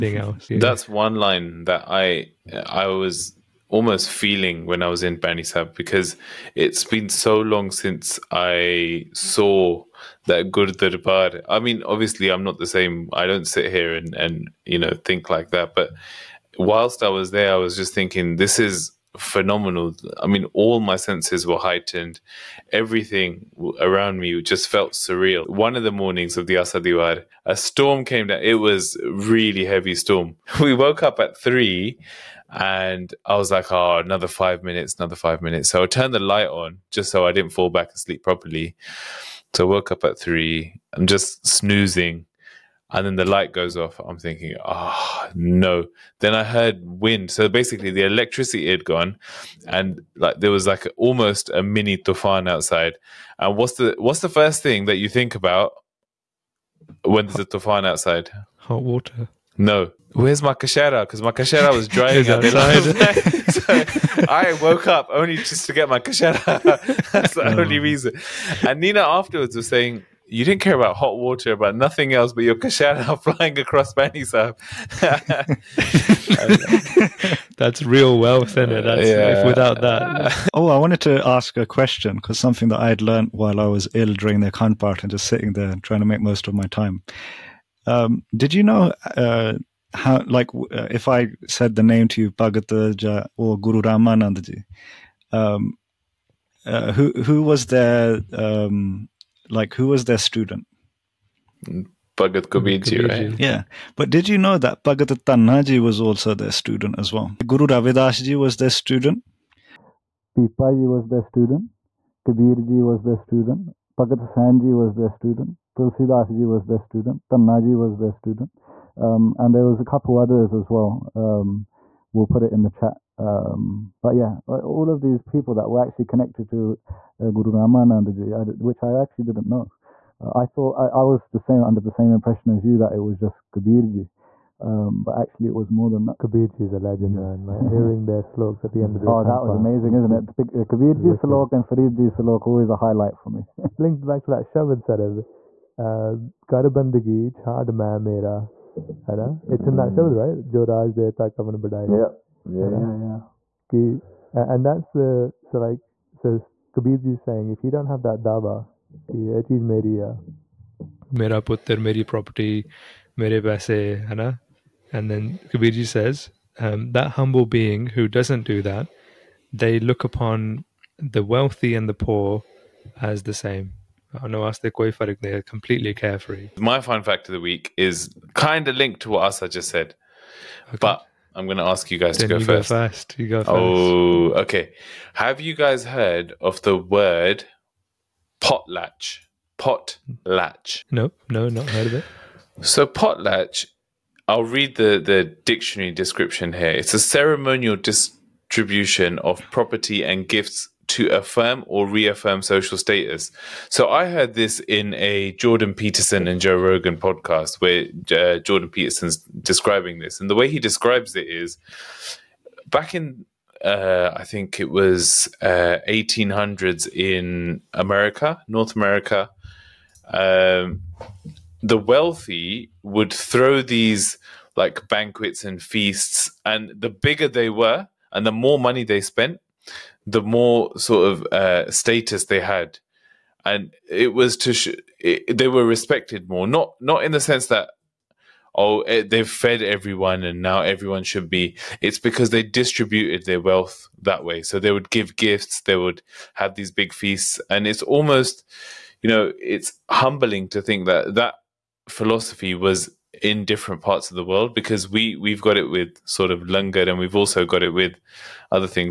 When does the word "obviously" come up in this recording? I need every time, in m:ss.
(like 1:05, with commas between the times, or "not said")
0:11.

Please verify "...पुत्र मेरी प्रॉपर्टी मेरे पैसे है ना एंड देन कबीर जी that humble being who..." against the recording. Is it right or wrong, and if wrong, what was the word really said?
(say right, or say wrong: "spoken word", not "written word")
right.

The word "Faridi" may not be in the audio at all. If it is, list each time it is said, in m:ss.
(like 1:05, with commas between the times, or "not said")
2:21.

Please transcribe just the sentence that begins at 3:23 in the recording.
So I heard this in a Jordan Peterson and Joe Rogan podcast where uh, Jordan Peterson's describing this.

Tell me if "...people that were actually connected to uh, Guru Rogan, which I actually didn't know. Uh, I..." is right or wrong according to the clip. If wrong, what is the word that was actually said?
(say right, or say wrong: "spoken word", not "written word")
wrong: "Ramanandaji", not "Rogan".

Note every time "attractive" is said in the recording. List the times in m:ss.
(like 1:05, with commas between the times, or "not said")
not said.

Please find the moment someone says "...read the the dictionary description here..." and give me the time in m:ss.
3:14.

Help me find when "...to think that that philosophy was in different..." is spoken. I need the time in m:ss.
4:10.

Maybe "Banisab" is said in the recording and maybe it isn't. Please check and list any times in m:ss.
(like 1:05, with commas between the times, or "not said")
0:05, 1:13.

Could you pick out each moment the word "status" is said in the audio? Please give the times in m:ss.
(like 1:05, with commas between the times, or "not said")
3:22, 3:51.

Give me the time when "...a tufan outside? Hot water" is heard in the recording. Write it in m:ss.
0:57.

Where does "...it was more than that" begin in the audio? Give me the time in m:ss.
2:15.